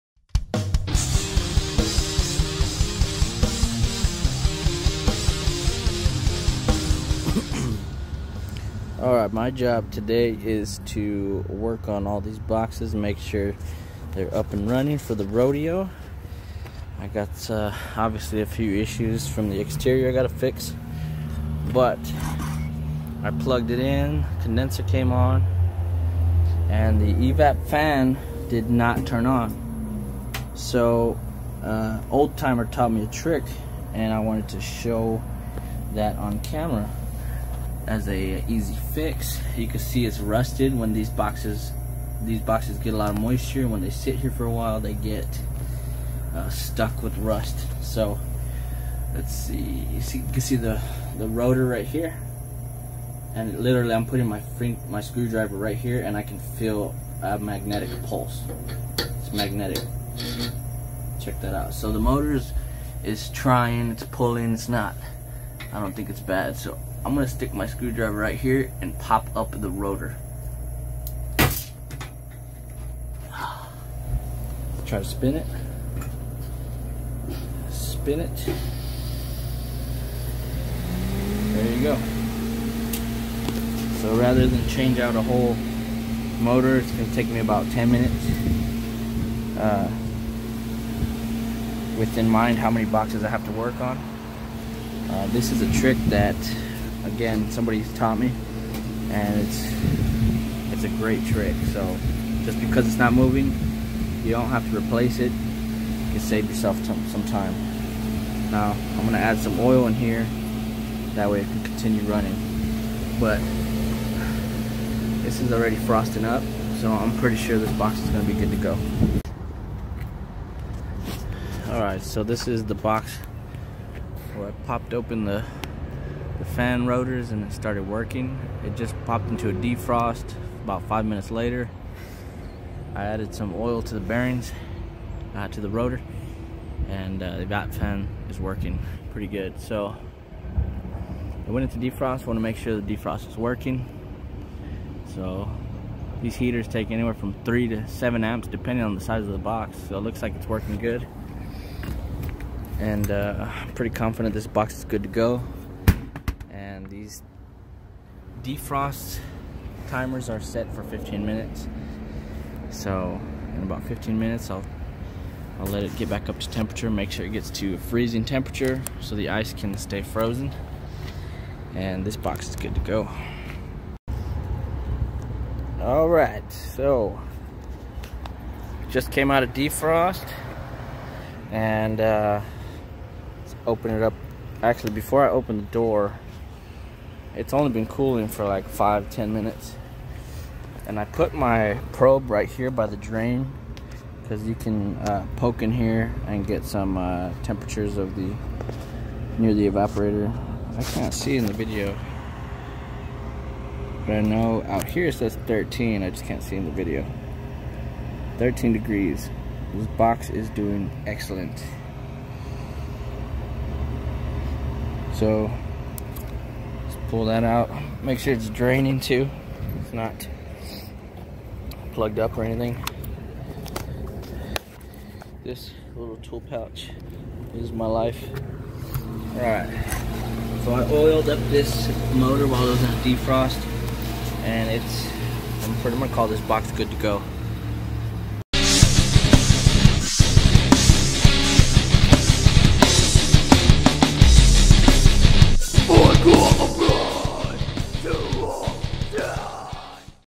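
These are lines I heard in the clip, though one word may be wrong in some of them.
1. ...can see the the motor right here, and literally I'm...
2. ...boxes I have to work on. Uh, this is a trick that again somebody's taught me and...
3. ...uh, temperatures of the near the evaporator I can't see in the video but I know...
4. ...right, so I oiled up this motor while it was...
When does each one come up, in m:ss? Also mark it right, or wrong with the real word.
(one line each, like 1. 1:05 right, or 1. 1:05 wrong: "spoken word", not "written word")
1. 0:50 wrong: "rotor", not "motor"
2. 1:32 right
3. 3:16 right
4. 3:49 right.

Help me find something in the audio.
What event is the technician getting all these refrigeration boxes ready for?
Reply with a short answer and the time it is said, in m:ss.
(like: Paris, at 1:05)
the rodeo, at 0:15.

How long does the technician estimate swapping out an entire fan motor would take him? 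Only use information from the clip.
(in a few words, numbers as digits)
10 minutes.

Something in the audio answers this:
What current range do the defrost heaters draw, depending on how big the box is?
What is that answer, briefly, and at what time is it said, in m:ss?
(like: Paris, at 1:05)
3 to 7 amps, at 2:27.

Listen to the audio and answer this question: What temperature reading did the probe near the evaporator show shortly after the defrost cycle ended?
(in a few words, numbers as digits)
13 degrees.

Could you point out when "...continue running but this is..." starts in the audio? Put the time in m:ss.
1:51.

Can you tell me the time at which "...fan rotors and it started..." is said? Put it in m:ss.
2:06.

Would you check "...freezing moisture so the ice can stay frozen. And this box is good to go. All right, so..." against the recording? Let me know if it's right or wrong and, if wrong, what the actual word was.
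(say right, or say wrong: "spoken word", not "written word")
wrong: "temperature", not "moisture".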